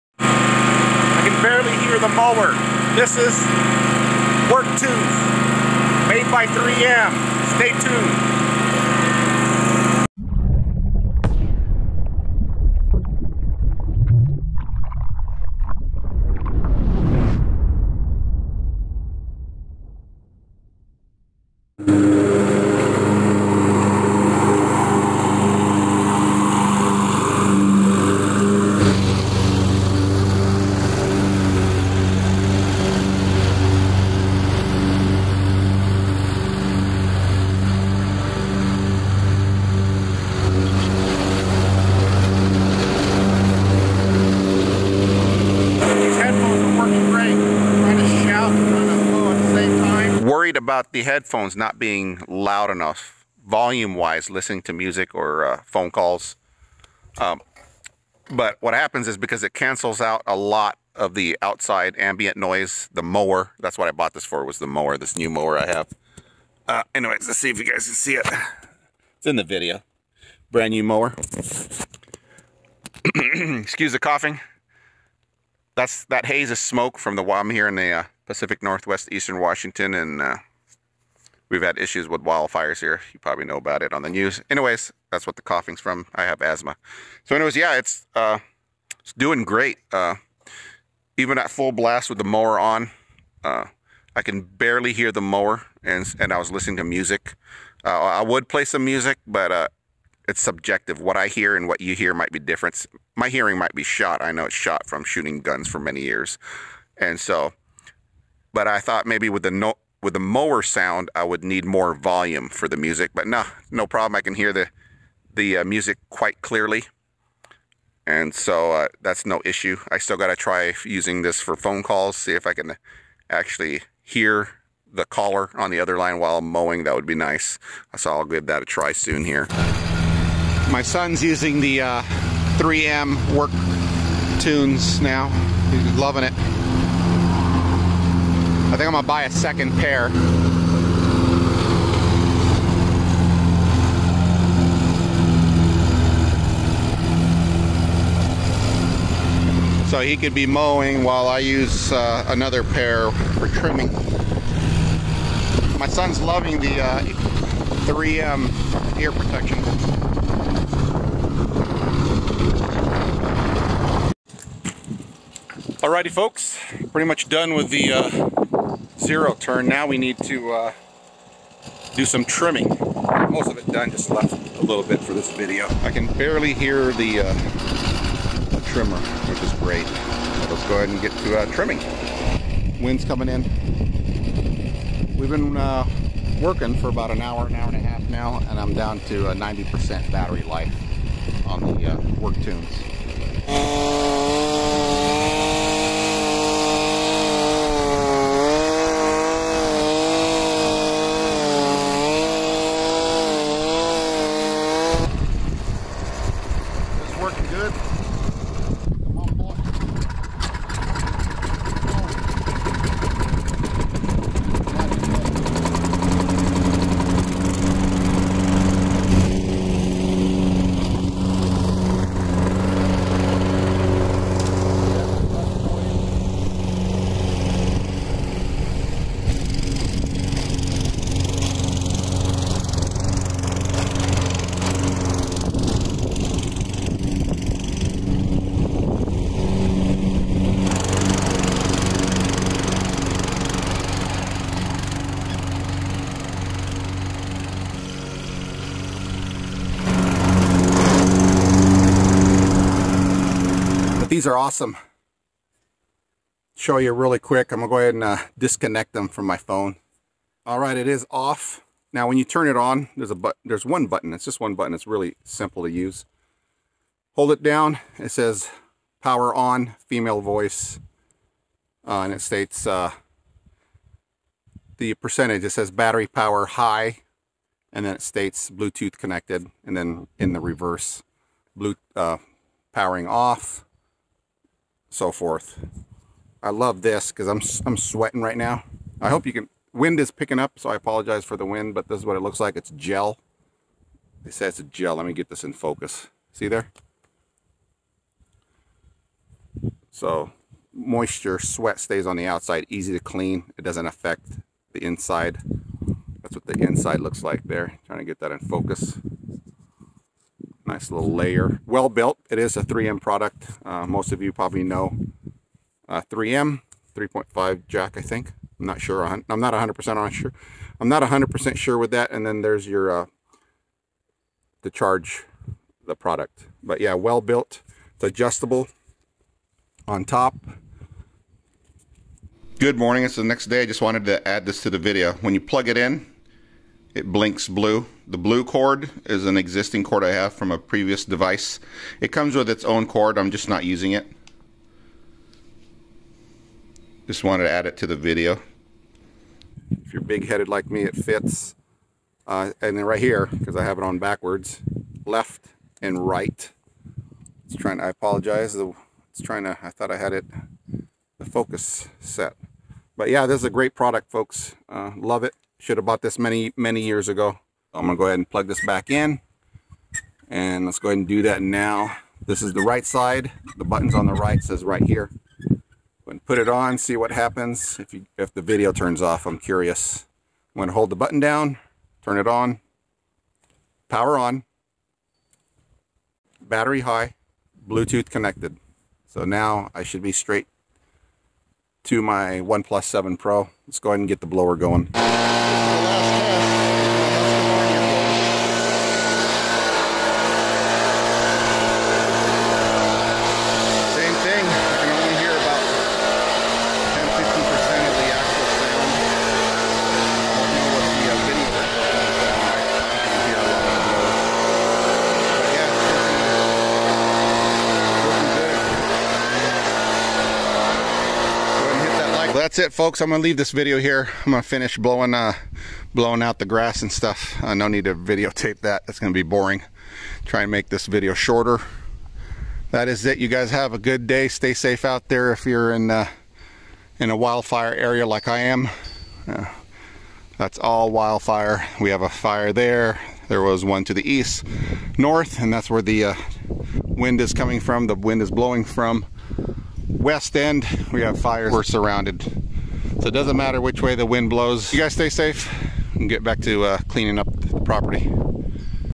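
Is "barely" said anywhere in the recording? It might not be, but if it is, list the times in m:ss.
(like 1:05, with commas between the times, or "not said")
1:34, 2:56.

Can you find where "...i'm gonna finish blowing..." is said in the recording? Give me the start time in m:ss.
7:04.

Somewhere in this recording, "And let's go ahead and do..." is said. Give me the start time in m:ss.
6:10.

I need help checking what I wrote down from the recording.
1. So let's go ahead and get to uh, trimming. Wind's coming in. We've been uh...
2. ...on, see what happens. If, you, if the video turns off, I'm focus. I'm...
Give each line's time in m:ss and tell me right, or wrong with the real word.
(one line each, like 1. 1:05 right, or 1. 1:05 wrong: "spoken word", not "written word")
1. 2:59 right
2. 6:16 wrong: "curious", not "focus".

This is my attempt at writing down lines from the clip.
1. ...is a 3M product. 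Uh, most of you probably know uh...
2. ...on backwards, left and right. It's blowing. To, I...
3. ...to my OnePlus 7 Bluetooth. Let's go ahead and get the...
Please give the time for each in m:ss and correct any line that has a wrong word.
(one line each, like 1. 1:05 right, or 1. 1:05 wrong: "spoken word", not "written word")
1. 5:12 right
2. 5:53 wrong: "trying", not "blowing"
3. 6:31 wrong: "Pro", not "Bluetooth".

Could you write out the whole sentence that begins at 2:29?
So he could be mowing while I use uh, another pair for trimming.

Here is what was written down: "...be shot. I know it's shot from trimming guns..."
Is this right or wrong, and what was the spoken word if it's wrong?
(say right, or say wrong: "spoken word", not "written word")
wrong: "shooting", not "trimming".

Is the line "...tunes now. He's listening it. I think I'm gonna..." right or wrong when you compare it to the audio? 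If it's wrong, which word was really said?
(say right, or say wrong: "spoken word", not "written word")
wrong: "loving", not "listening".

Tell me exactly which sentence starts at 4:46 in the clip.
I love this because I'm, I'm sweating right now.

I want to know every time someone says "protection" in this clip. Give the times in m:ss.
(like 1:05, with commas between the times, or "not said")
2:39.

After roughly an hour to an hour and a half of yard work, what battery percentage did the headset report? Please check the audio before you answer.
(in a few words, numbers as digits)
90%.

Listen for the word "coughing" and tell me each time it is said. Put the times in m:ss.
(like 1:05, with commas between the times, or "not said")
1:13, 1:25.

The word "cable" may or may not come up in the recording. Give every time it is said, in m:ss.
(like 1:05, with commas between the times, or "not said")
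not said.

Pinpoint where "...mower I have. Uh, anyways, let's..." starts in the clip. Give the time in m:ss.
1:05.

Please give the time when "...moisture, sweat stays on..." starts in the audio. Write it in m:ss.
5:00.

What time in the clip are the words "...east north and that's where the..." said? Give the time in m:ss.
7:24.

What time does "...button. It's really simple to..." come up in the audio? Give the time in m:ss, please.
4:24.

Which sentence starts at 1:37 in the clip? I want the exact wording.
Uh, I would play some music, but uh, it's subjective.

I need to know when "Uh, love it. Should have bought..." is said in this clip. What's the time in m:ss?
6:04.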